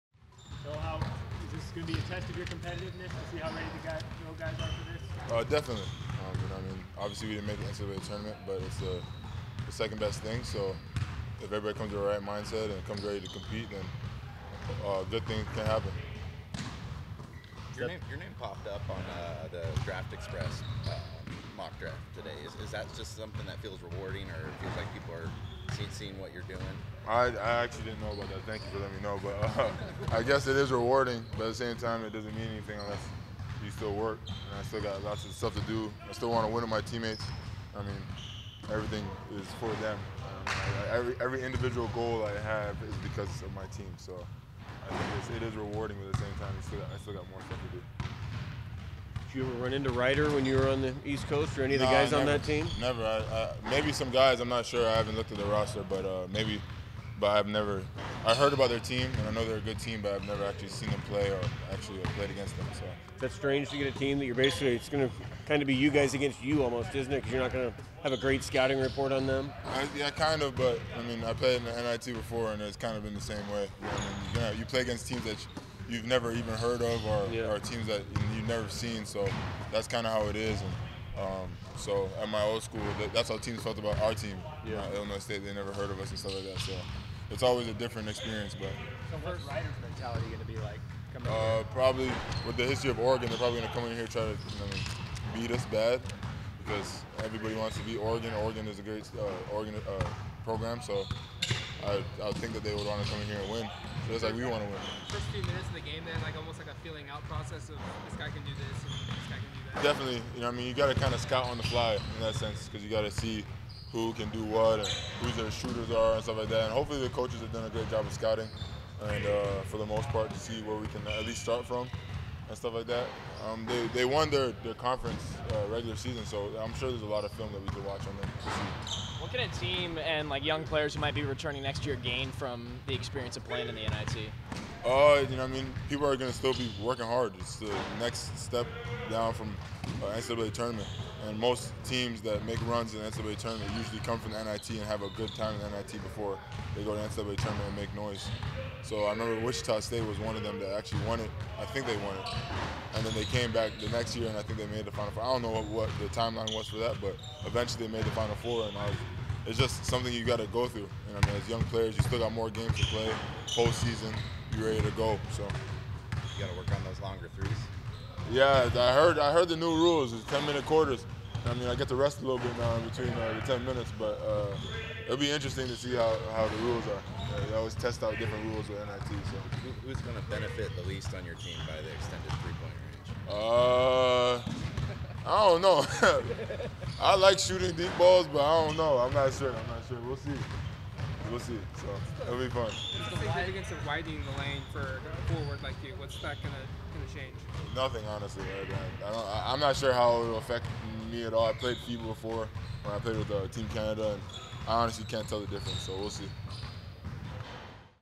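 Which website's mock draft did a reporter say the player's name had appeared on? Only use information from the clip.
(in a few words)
Draft Express.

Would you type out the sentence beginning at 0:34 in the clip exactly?
And I still got lots of stuff to do.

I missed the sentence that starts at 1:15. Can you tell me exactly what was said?
You, you've never even heard of or, yeah.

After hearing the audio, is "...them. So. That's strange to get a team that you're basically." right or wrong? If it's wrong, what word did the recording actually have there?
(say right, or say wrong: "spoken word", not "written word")
right.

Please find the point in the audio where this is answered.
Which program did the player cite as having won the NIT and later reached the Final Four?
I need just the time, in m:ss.
2:29.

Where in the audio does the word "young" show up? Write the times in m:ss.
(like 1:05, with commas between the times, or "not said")
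2:10, 2:41.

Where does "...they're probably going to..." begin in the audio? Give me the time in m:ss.
1:33.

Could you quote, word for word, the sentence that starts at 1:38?
Oregon is a great uh, Oregon uh, program, so I, I think that they would want to come in here and win.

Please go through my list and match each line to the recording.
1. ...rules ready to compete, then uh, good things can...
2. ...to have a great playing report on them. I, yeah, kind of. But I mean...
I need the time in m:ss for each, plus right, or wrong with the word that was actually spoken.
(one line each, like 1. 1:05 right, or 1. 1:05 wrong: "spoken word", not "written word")
1. 0:12 wrong: "comes", not "rules"
2. 1:07 wrong: "scouting", not "playing".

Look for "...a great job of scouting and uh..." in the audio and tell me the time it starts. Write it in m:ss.
1:57.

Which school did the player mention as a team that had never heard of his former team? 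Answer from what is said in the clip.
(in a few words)
Illinois State.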